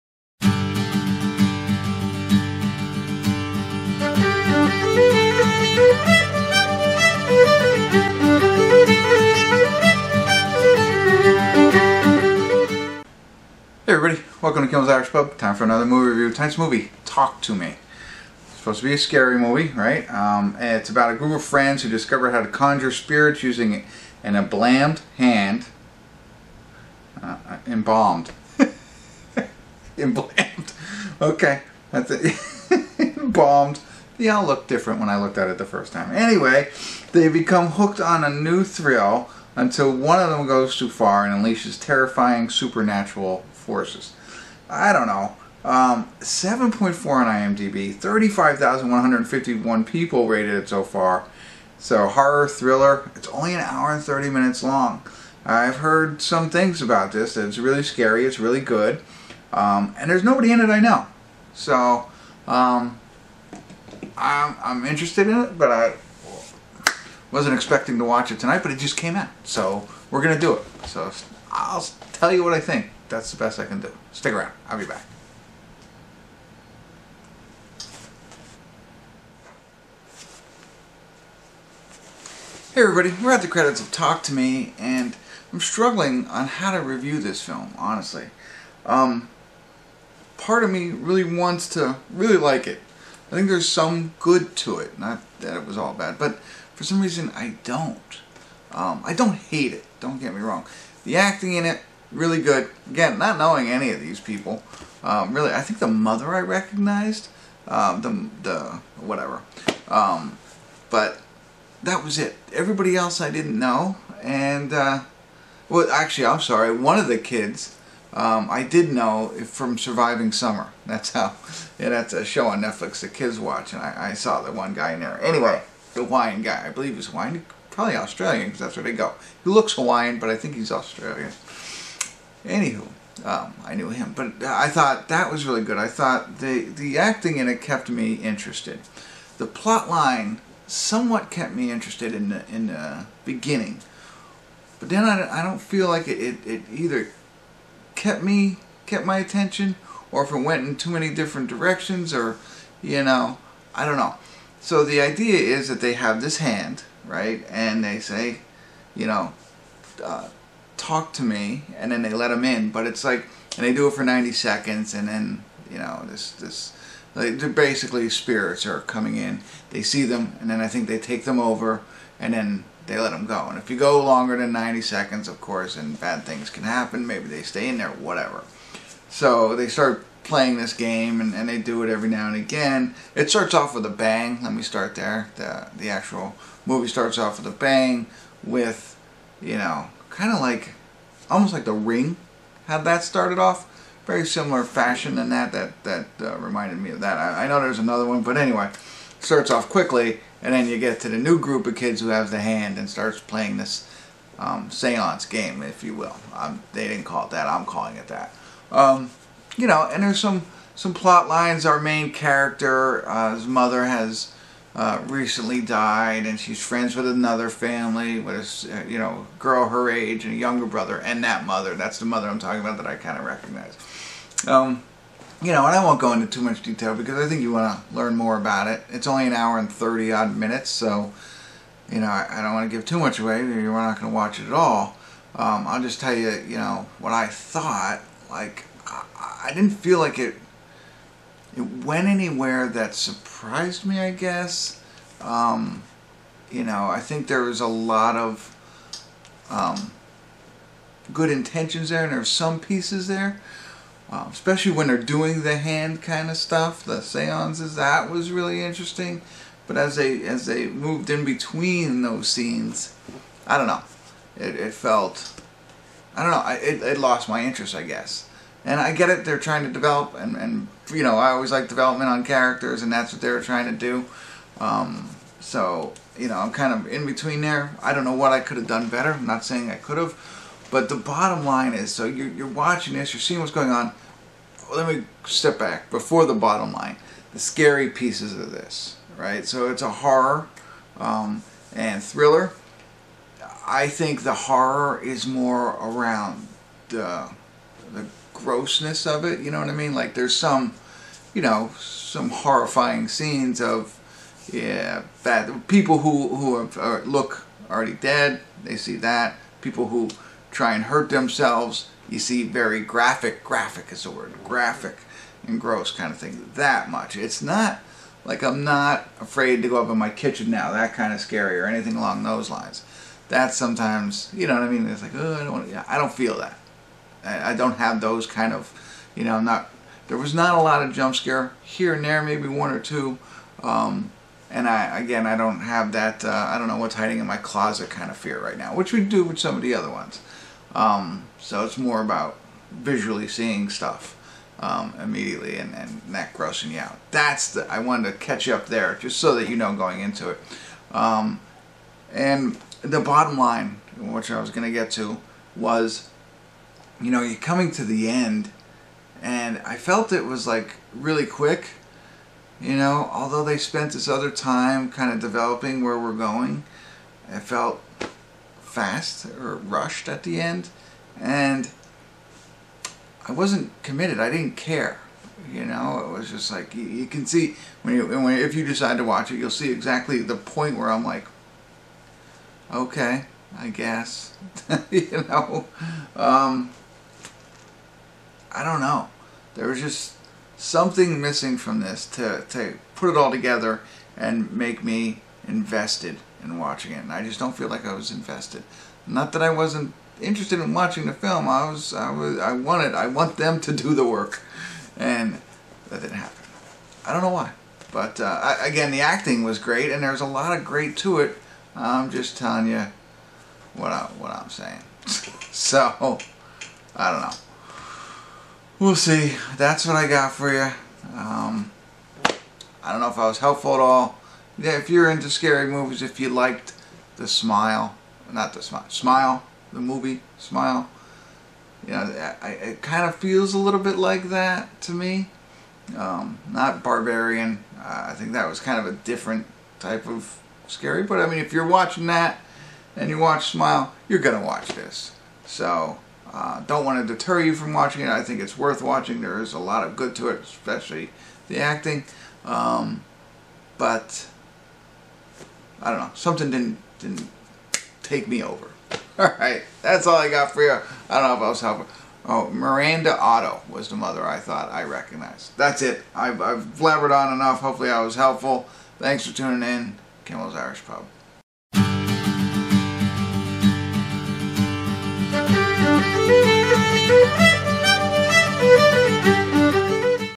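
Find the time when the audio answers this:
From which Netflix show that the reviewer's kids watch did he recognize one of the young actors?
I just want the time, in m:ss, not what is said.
1:59.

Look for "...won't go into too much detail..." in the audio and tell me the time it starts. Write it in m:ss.
3:45.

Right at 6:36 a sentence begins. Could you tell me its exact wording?
And I just don't feel like I was invested.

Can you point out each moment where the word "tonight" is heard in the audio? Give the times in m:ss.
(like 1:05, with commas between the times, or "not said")
0:16, 1:08.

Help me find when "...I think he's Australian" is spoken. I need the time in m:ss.
2:10.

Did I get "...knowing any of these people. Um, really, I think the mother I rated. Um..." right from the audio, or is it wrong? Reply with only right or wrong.
wrong.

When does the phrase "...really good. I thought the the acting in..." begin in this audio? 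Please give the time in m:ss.
2:15.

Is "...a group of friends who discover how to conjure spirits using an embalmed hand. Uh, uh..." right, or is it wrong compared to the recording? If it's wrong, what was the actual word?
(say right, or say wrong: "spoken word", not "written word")
right.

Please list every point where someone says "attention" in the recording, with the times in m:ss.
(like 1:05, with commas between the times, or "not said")
2:29.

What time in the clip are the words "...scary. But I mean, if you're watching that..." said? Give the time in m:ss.
7:20.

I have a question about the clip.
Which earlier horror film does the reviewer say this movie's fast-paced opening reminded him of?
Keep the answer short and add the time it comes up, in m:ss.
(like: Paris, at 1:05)
The Ring, at 3:11.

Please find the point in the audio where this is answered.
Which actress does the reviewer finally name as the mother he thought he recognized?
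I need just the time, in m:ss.
7:42.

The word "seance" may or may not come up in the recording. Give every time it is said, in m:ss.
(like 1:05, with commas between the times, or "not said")
3:24, 4:17.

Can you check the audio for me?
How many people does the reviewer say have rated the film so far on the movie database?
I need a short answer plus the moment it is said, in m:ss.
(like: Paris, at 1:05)
35,151, at 0:47.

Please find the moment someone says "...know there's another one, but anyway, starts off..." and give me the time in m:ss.
3:17.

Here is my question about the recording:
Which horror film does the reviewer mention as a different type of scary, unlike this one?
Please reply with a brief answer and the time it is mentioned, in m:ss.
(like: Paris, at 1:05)
Barbarian, at 7:16.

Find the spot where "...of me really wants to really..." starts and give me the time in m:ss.
1:30.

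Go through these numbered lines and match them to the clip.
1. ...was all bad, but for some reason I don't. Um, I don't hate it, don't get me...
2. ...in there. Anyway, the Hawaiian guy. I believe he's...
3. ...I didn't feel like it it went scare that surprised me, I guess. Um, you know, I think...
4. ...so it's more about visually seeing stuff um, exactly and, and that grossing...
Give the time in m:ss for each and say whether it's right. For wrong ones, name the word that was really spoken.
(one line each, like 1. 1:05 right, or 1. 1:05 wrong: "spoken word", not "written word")
1. 1:35 right
2. 2:04 right
3. 3:59 wrong: "anywhere", not "scare"
4. 5:41 wrong: "immediately", not "exactly".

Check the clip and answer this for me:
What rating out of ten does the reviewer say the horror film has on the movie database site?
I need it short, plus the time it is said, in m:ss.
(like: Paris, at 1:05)
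7.4, at 0:46.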